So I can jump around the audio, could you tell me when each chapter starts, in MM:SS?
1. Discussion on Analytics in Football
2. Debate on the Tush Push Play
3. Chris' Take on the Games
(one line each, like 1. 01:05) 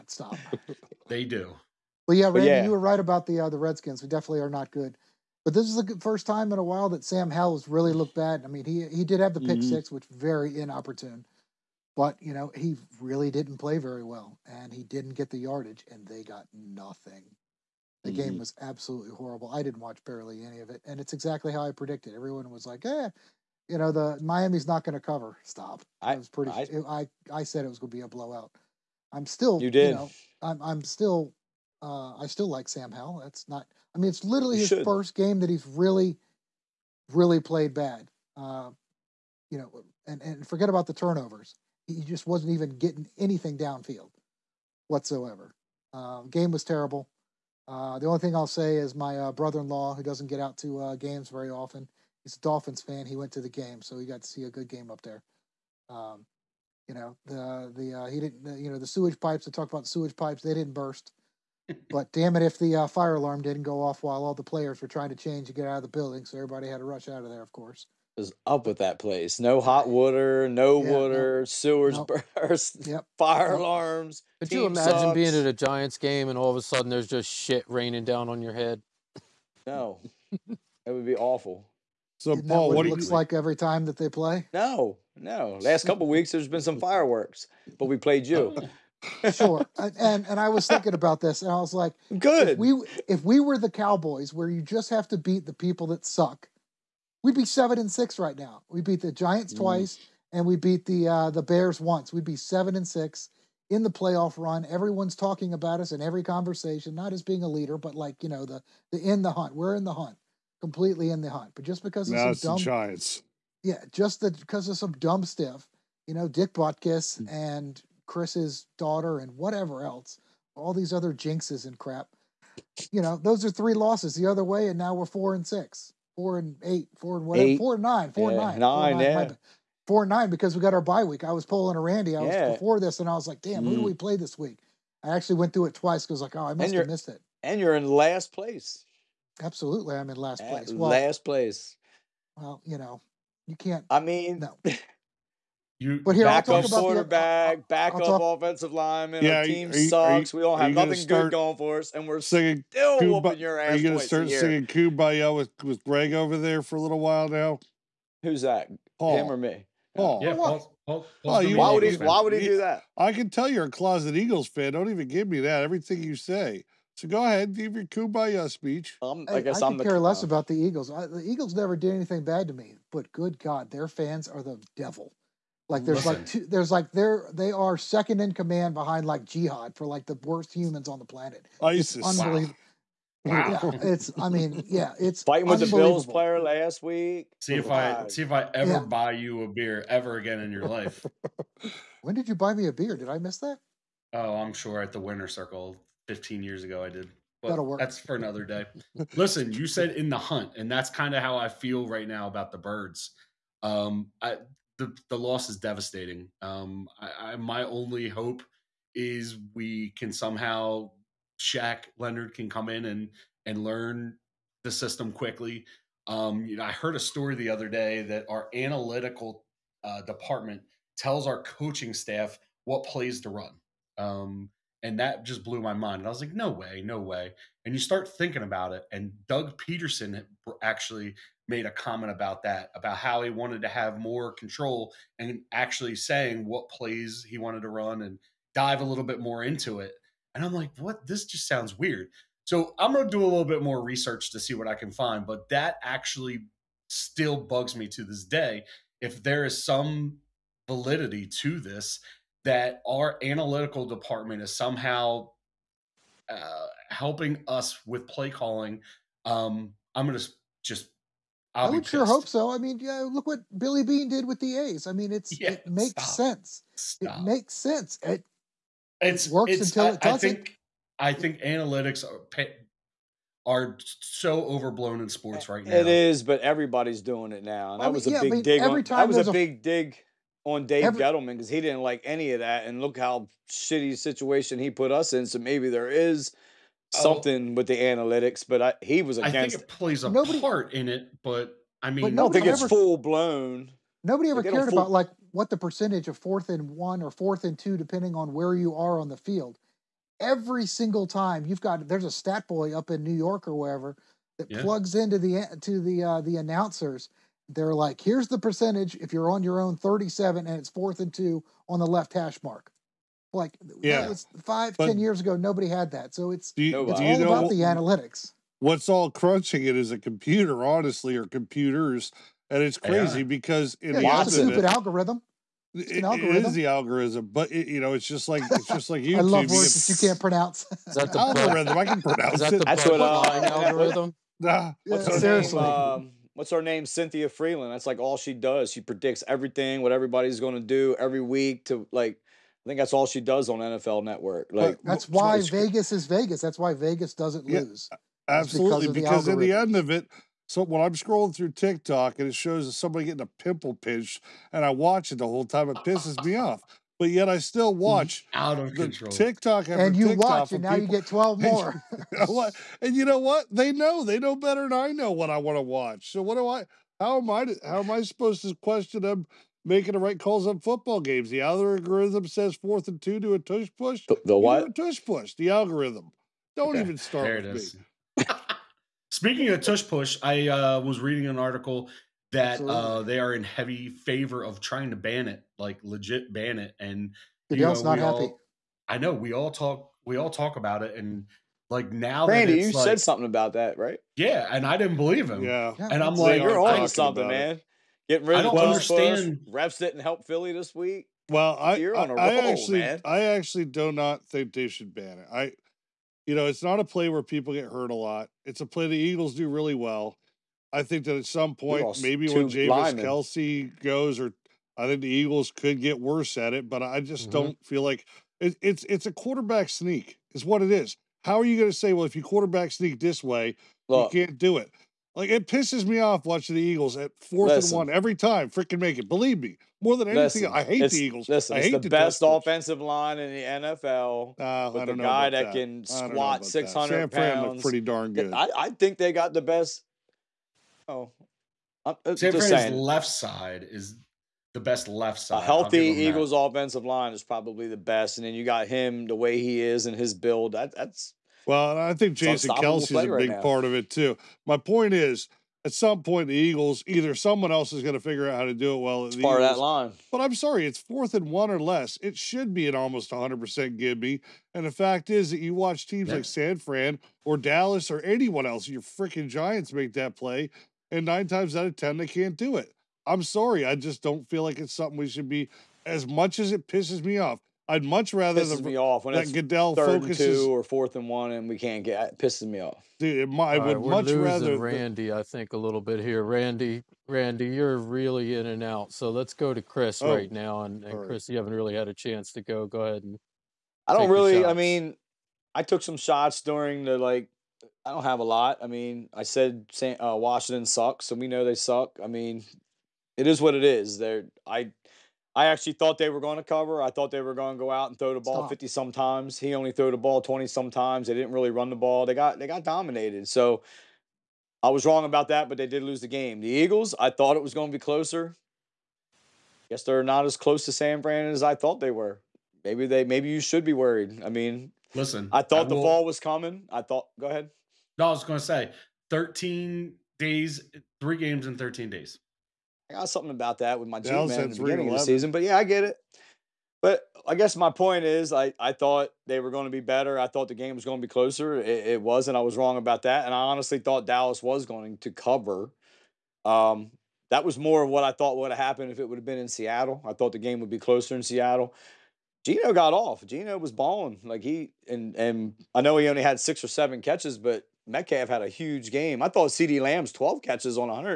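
1. 02:54
2. 05:54
3. 07:54.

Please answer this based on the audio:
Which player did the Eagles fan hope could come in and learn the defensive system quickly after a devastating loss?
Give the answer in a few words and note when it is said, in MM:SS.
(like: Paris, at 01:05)
Shaq Leonard, at 03:31.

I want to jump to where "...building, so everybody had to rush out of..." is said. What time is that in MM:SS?
01:05.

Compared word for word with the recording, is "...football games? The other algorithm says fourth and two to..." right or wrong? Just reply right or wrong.
right.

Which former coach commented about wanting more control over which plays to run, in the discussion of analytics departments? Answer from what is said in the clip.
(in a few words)
Doug Pederson.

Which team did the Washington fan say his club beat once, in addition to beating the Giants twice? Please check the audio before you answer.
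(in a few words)
Bears.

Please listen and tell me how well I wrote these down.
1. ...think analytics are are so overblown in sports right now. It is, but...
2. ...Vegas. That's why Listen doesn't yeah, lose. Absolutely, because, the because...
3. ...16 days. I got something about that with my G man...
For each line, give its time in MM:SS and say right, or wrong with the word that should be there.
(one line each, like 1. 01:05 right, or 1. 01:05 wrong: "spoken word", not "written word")
1. 04:31 right
2. 05:46 wrong: "Vegas", not "Listen"
3. 08:51 wrong: "13", not "16".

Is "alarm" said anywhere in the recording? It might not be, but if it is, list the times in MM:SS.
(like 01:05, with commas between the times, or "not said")
01:03, 01:13.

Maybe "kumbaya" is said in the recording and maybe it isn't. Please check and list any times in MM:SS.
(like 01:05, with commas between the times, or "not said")
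02:34, 02:47.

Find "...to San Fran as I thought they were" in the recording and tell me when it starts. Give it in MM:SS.
08:40.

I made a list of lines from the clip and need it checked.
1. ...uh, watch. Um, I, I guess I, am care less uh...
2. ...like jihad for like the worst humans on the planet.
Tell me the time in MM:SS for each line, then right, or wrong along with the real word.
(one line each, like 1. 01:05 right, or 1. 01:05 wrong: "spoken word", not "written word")
1. 02:48 wrong: "speech", not "watch"
2. 02:59 right.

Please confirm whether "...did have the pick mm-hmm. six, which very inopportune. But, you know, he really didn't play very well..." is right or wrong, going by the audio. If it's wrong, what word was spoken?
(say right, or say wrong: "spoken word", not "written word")
right.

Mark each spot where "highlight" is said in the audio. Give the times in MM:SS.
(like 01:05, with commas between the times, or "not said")
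not said.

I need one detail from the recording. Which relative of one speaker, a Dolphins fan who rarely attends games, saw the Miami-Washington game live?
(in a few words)
Brother-in-law.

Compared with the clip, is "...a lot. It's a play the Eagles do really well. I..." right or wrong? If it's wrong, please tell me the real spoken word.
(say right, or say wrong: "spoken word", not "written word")
right.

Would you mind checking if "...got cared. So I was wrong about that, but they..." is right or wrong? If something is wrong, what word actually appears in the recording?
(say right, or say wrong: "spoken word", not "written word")
wrong: "dominated", not "cared".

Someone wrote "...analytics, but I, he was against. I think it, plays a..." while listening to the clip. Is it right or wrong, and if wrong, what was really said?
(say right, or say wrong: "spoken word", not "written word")
right.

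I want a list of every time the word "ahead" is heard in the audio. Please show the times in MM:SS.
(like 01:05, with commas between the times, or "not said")
02:47, 08:12, 08:47.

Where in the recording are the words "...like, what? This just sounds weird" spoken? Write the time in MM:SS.
04:00.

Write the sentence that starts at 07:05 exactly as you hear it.
Like it pisses me off watching the Eagles at fourth listen, and one every time.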